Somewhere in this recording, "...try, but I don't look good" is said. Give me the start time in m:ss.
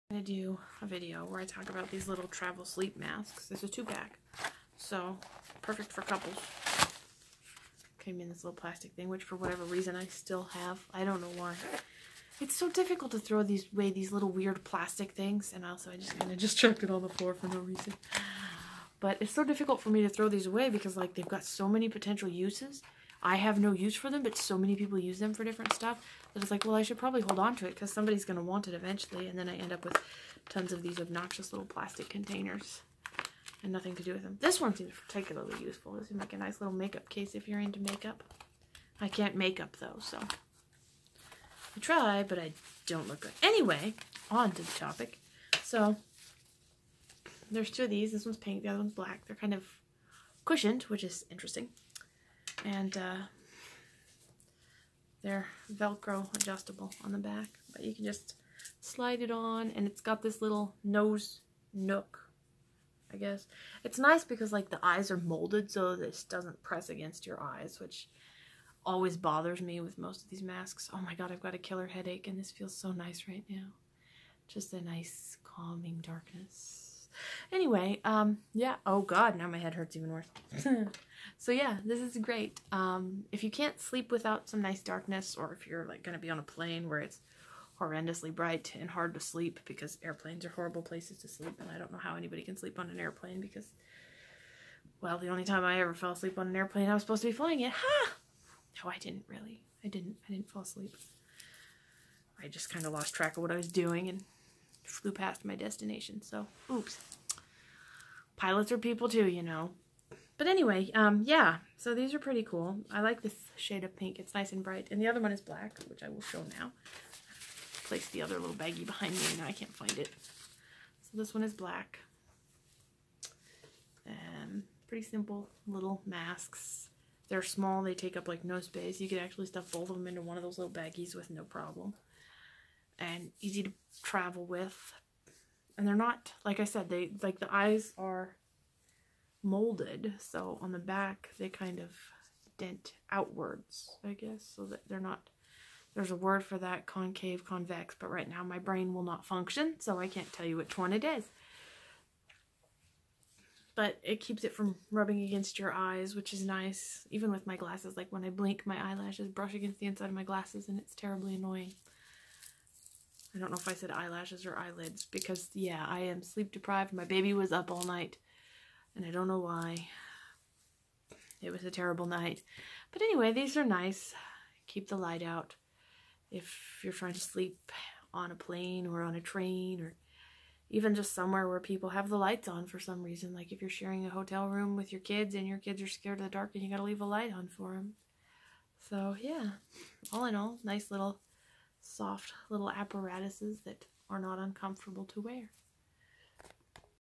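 0:41.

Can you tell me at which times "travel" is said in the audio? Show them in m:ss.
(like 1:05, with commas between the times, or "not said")
0:02, 2:14.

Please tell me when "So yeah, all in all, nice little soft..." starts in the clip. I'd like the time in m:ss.
3:08.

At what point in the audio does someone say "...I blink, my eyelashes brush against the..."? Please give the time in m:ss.
2:38.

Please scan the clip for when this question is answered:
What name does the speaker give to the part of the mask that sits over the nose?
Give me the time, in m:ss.
1:00.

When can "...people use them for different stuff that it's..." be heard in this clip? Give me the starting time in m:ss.
0:24.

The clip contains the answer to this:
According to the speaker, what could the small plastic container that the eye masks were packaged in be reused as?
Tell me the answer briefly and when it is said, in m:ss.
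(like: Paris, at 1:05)
makeup case, at 0:36.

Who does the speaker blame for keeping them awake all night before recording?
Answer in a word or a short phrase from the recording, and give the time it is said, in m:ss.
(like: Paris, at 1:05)
baby, at 2:46.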